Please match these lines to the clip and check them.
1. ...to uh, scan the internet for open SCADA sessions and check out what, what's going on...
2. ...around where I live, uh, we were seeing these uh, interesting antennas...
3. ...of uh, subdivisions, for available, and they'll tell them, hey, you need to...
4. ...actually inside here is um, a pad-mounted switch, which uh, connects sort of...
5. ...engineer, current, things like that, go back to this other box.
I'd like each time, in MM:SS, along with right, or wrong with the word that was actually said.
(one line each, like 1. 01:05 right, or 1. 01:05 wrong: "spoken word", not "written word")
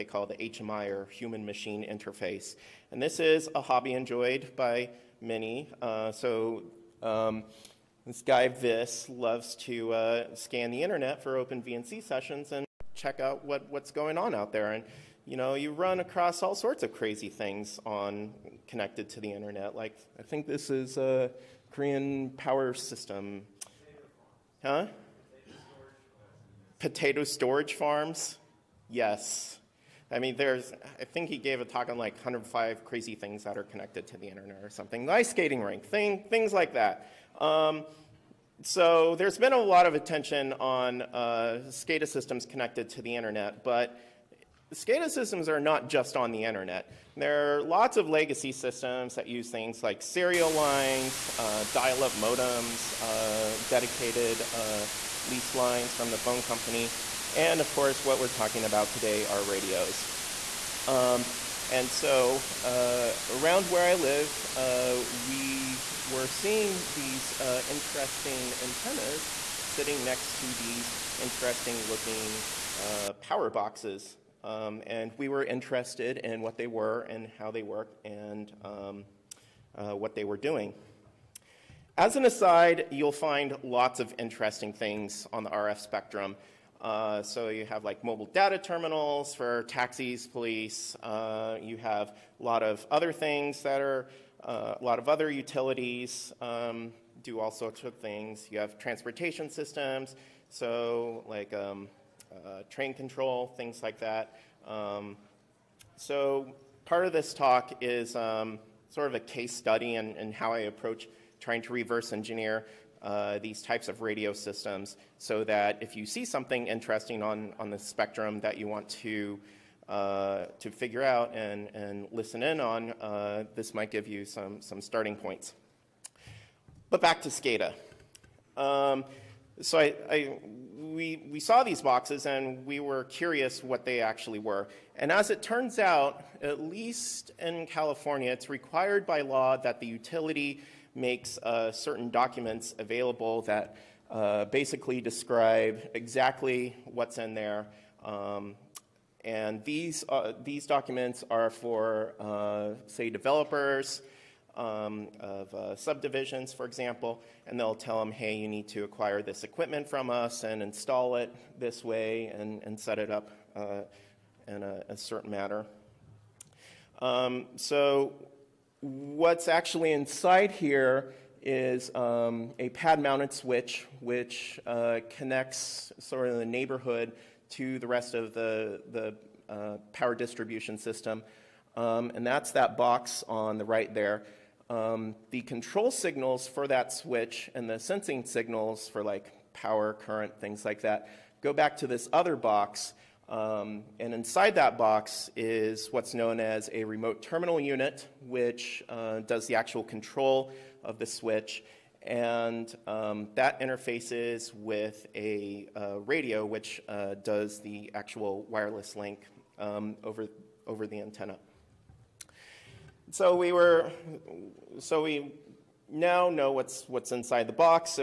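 1. 00:09 wrong: "VNC", not "SCADA"
2. 01:03 right
3. 02:35 wrong: "example", not "available"
4. 02:49 right
5. 03:09 wrong: "power", not "engineer".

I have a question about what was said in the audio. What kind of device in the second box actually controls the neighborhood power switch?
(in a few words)
remote terminal unit.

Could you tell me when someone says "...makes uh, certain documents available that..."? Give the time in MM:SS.
02:20.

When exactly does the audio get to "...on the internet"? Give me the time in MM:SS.
00:46.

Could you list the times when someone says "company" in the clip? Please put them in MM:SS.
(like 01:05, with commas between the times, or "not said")
00:56.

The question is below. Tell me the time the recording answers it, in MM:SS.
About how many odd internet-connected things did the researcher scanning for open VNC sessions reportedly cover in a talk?
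00:32.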